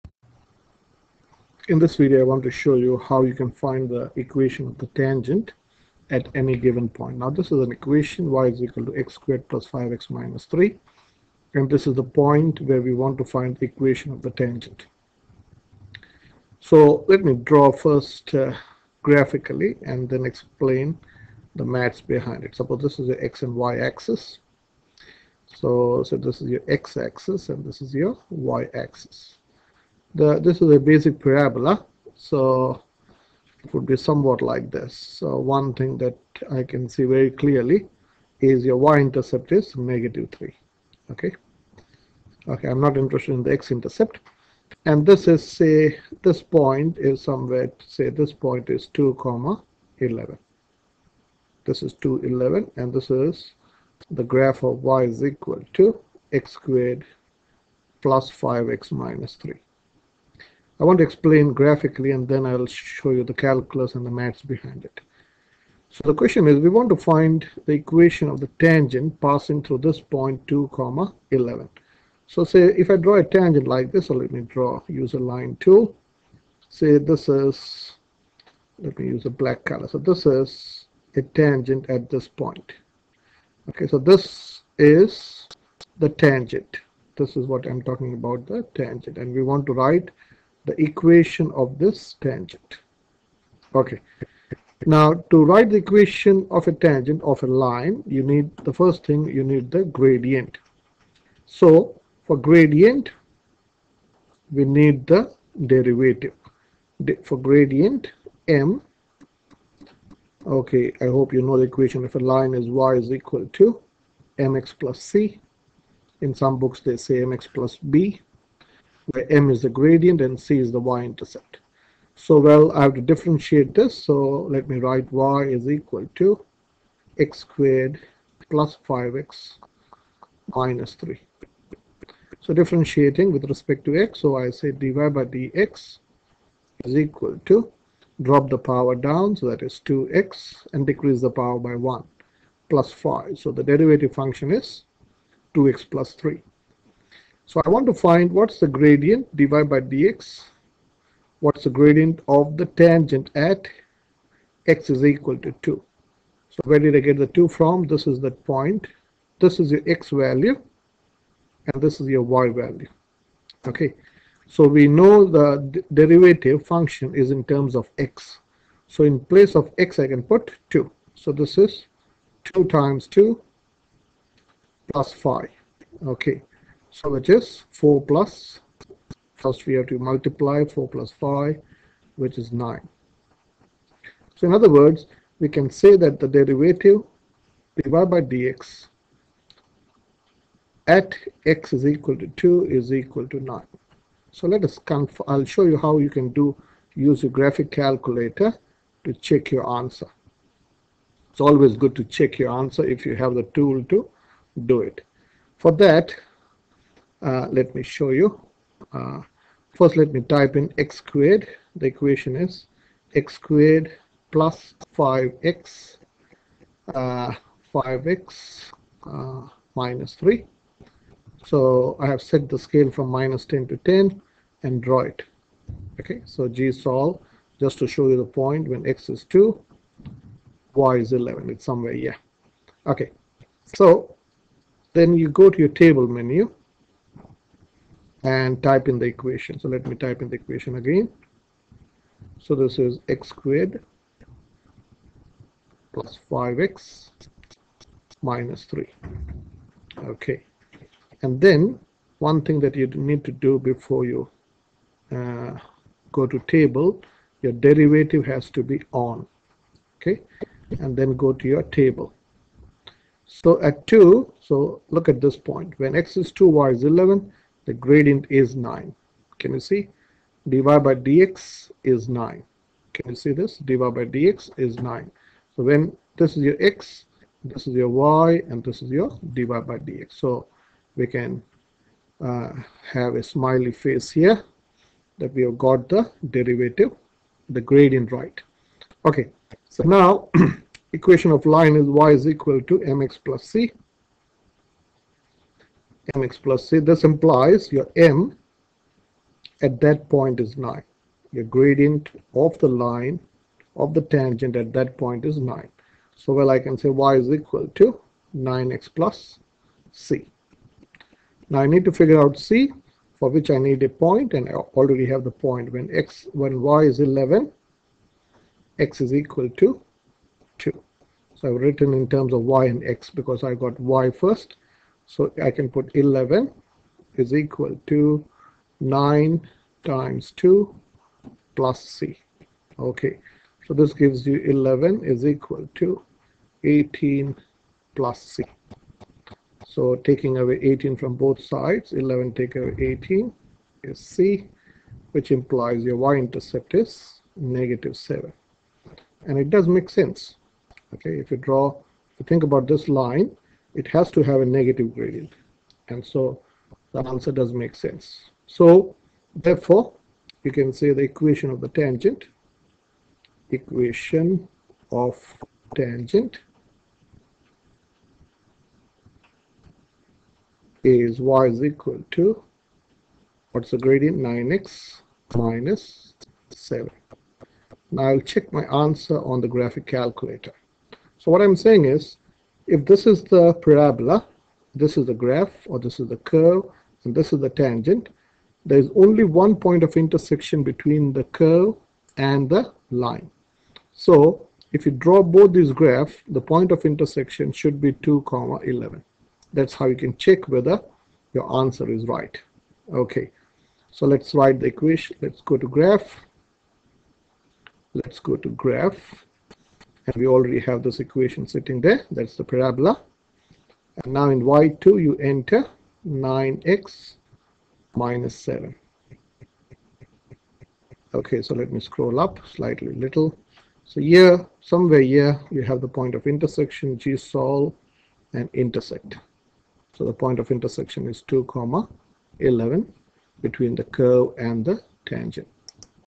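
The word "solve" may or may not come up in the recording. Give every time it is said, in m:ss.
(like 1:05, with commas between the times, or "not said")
3:46, 7:07.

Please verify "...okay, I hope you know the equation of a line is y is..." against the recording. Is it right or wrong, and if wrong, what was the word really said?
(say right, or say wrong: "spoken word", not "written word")
right.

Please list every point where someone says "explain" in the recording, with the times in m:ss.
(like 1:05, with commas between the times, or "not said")
0:20, 1:01.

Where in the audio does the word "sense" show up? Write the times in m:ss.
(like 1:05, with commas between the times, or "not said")
5:49, 5:57.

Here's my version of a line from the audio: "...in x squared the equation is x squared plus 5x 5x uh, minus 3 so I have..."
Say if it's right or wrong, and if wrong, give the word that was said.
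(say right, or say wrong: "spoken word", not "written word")
right.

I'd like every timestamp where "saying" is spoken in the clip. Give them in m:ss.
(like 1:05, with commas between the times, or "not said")
6:21.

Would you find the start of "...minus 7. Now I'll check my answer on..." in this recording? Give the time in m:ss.
6:15.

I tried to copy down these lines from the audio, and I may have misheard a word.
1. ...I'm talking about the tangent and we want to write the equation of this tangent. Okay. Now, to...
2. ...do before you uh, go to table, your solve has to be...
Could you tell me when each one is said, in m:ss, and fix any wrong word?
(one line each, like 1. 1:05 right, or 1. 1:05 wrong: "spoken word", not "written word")
1. 1:27 right
2. 4:13 wrong: "derivative", not "solve".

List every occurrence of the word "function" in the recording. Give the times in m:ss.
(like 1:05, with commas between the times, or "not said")
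2:24, 2:46.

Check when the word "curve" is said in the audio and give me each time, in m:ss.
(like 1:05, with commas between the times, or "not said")
6:26, 6:31, 7:13.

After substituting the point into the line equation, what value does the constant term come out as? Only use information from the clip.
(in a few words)
-7.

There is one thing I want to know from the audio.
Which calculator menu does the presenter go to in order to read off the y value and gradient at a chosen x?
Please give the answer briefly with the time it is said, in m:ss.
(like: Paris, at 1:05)
table menu, at 3:55.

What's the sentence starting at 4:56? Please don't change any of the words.
This implies your m at that point is 9.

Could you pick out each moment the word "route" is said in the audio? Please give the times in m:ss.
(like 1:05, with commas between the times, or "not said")
not said.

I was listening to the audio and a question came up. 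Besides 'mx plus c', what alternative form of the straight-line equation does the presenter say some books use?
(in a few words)
mx plus b.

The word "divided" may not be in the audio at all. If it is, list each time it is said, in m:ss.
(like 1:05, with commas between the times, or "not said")
2:29, 3:07.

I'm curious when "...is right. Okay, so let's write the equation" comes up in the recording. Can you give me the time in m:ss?
6:41.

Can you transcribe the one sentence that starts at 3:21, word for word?
It's always good to check your answer if you have the tool to do it.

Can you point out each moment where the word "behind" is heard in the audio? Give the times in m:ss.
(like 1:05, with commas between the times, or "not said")
0:22, 1:04.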